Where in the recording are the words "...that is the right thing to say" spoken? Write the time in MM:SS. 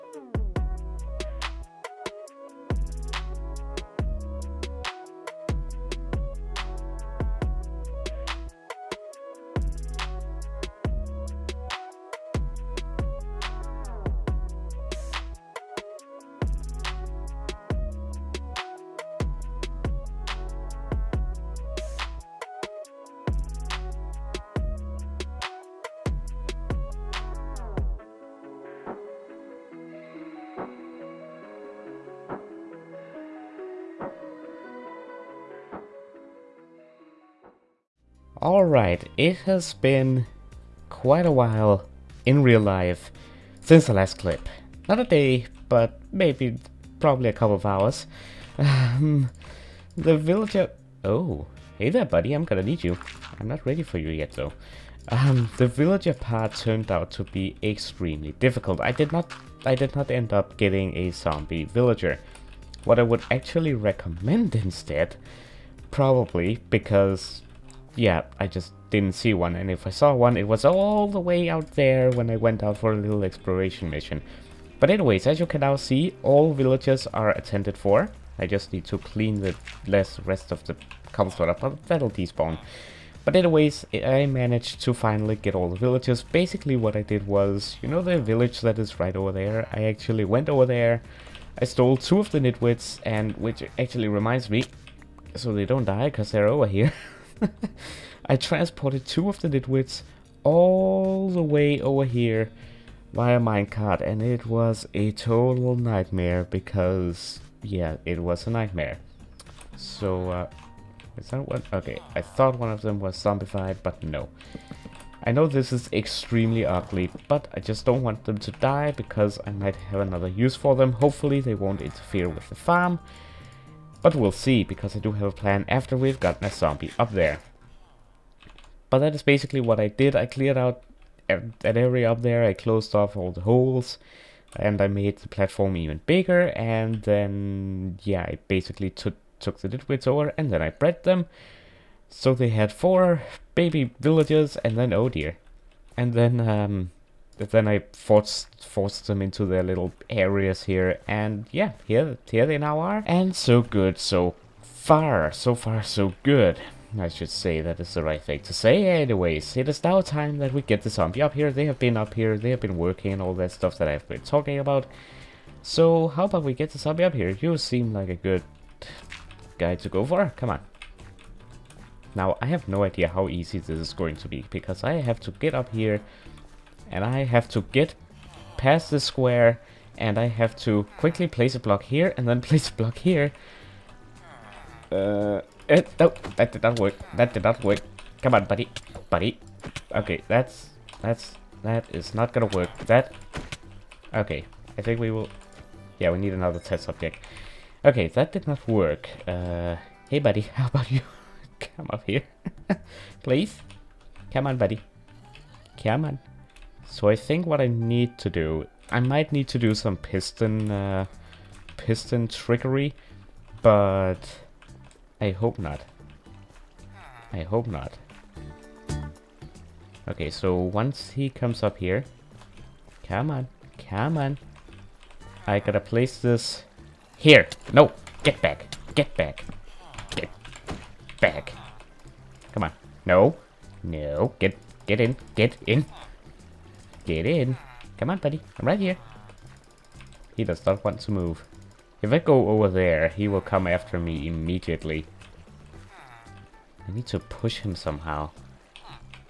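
02:37.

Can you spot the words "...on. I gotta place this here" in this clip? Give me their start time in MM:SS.
03:44.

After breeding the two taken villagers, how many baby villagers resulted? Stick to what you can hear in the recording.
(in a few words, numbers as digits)
4.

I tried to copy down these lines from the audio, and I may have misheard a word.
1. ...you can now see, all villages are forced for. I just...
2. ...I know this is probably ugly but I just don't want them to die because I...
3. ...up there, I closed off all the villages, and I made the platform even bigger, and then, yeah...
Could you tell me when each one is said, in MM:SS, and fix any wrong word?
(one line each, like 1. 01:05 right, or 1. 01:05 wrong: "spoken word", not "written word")
1. 01:15 wrong: "attended", not "forced"
2. 01:55 wrong: "extremely", not "probably"
3. 02:12 wrong: "holes", not "villages".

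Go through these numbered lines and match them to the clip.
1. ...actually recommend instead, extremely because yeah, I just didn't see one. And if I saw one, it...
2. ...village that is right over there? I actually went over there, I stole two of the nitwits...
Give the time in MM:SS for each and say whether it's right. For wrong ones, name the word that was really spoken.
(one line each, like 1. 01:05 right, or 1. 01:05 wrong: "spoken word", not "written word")
1. 01:03 wrong: "probably", not "extremely"
2. 01:28 right.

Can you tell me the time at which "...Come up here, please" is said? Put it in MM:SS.
03:21.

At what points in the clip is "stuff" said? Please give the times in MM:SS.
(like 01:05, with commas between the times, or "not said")
02:43.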